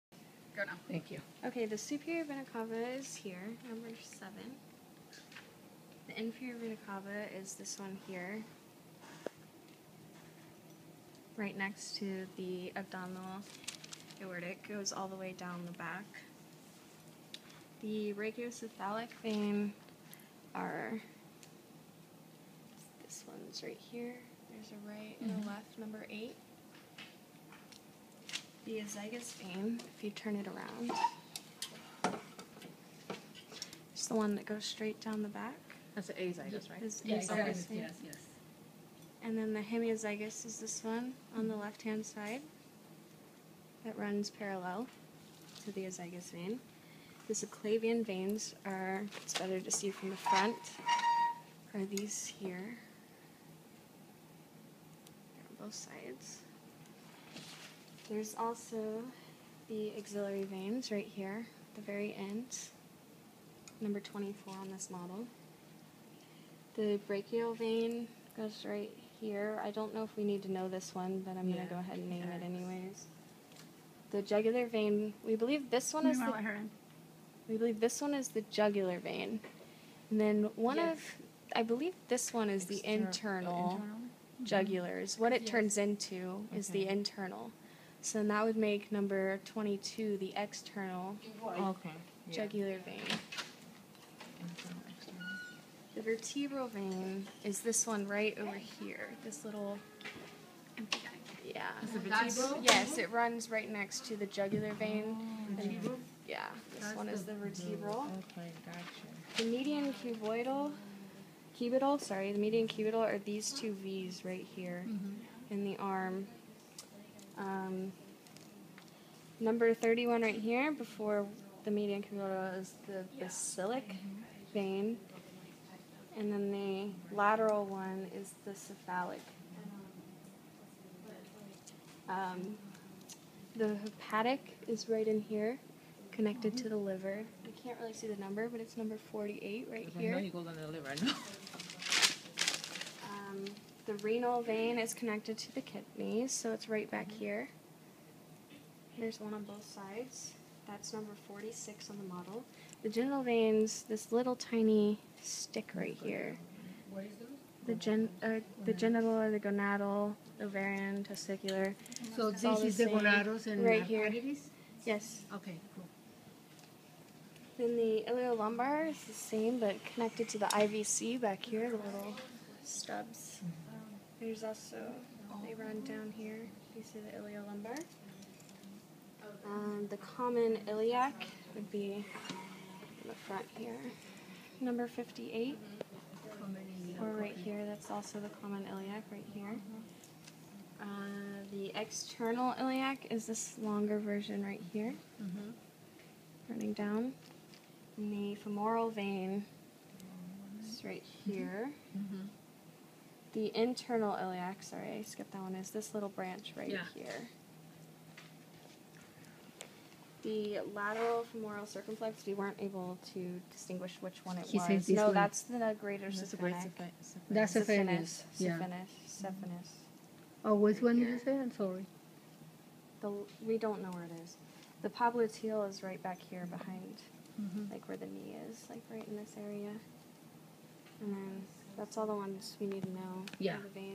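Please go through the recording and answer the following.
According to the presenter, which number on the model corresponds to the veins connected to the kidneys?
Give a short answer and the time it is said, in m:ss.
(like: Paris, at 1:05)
46, at 2:31.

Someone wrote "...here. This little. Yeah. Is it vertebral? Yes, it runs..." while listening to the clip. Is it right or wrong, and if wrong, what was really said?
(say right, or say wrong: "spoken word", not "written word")
right.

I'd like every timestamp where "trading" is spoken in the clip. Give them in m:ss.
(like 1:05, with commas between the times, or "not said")
not said.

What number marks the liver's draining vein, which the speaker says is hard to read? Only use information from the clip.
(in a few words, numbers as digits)
48.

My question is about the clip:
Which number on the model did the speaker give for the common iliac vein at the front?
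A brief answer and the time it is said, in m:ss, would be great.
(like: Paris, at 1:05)
58, at 3:04.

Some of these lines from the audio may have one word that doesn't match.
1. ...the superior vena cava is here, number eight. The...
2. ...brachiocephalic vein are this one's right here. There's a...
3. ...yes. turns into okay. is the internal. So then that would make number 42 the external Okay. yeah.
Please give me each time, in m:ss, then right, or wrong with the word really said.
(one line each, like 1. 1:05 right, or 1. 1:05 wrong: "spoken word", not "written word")
1. 0:01 wrong: "seven", not "eight"
2. 0:18 right
3. 1:25 wrong: "22", not "42".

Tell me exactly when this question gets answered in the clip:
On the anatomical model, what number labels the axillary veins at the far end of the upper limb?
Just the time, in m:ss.
1:04.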